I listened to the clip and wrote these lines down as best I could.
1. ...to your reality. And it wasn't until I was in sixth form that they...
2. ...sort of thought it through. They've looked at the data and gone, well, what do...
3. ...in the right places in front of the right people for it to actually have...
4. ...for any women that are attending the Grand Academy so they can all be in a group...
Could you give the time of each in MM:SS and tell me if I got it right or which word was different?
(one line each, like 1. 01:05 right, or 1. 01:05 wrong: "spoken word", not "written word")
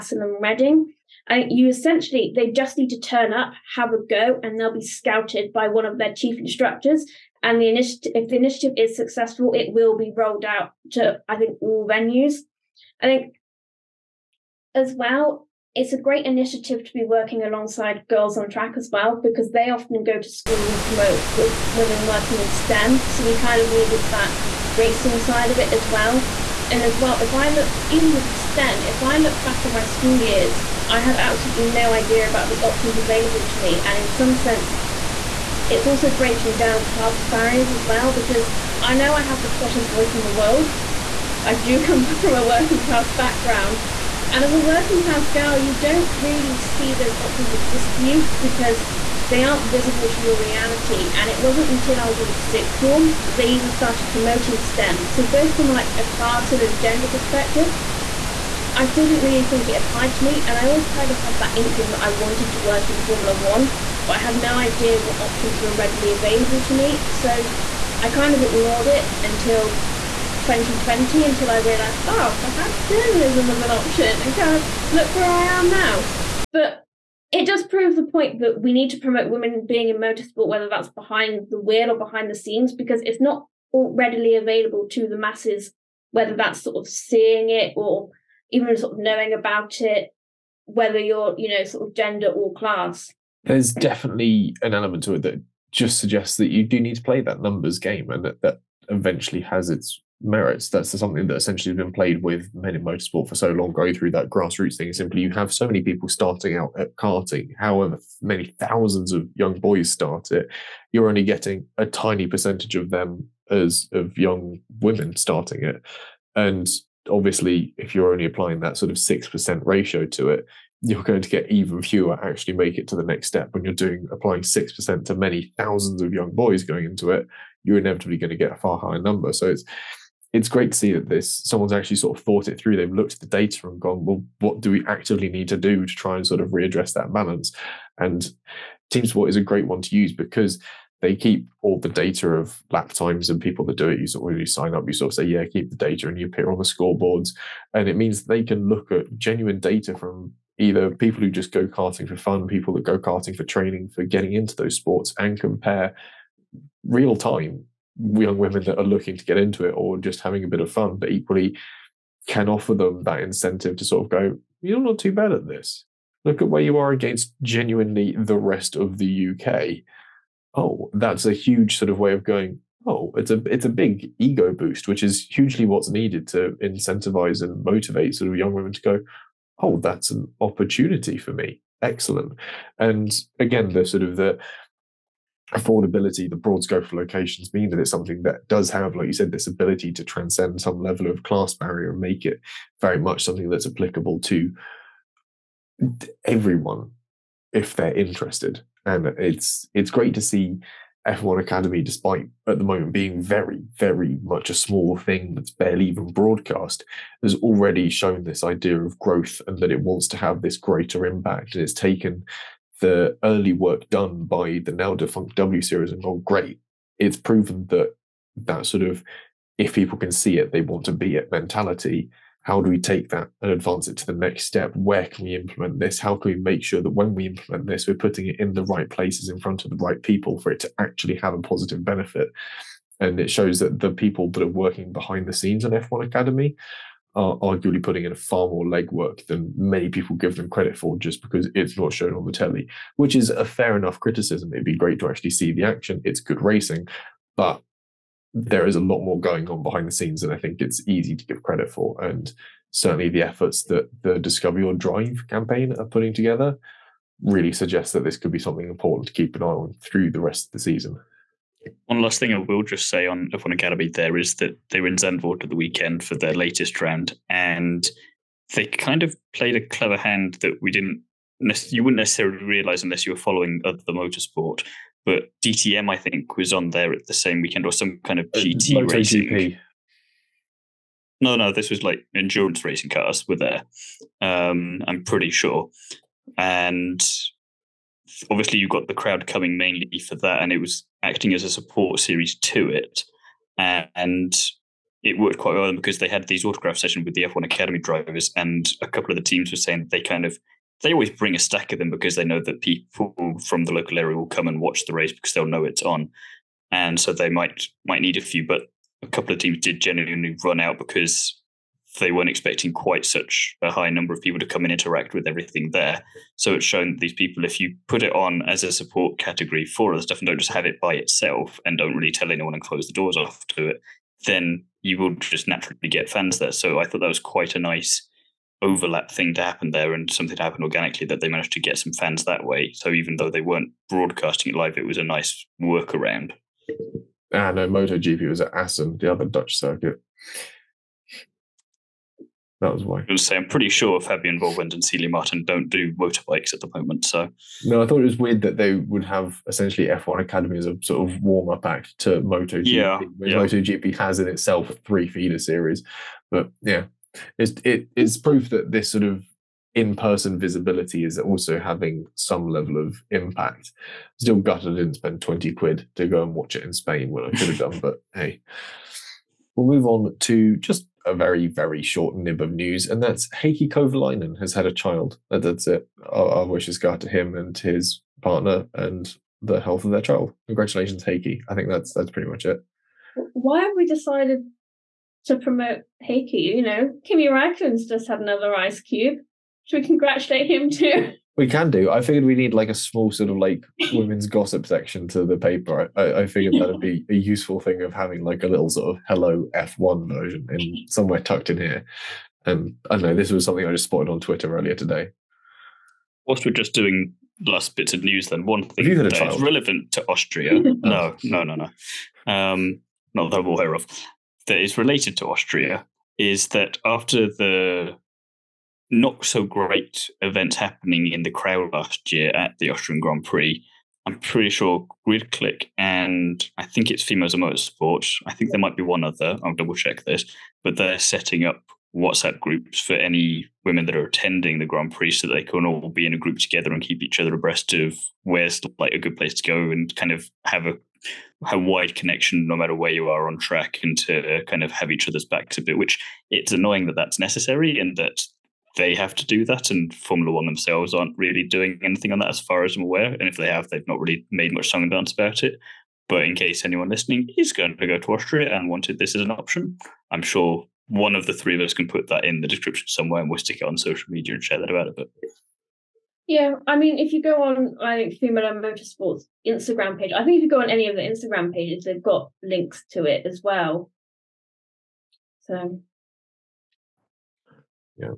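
1. 00:50 right
2. 02:11 right
3. 03:48 right
4. 07:12 wrong: "Prix", not "Academy".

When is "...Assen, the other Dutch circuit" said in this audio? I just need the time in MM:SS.
05:38.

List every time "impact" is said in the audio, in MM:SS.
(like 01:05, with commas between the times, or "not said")
03:31, 06:03.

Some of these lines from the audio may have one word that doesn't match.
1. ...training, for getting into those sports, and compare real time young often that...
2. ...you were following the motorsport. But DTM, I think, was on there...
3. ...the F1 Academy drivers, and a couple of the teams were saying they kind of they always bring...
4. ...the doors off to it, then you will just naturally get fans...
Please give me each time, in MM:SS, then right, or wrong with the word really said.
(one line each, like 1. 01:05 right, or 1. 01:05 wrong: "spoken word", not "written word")
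1. 02:33 wrong: "women", not "often"
2. 04:33 right
3. 04:57 right
4. 05:22 right.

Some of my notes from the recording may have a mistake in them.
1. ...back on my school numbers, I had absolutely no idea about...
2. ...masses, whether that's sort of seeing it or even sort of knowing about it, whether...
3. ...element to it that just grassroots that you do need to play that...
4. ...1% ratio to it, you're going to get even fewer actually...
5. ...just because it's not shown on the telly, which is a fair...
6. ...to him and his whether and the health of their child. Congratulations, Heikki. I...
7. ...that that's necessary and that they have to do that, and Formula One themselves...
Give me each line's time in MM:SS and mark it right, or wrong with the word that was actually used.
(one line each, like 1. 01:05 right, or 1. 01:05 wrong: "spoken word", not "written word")
1. 00:29 wrong: "years", not "numbers"
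2. 01:25 right
3. 01:34 wrong: "suggests", not "grassroots"
4. 01:58 wrong: "6", not "1"
5. 04:00 right
6. 06:17 wrong: "partner", not "whether"
7. 07:26 right.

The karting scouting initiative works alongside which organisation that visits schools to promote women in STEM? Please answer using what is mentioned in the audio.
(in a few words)
Girls on Track.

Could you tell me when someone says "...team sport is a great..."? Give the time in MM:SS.
02:18.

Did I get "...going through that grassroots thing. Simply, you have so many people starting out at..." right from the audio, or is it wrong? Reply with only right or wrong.
right.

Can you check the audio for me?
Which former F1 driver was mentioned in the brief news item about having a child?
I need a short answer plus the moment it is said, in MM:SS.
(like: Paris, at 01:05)
Heikki Kovalainen, at 06:13.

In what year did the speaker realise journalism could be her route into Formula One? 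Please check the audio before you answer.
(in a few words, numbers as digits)
2020.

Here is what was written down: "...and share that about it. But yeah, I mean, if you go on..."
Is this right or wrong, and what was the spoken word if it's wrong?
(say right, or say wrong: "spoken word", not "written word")
right.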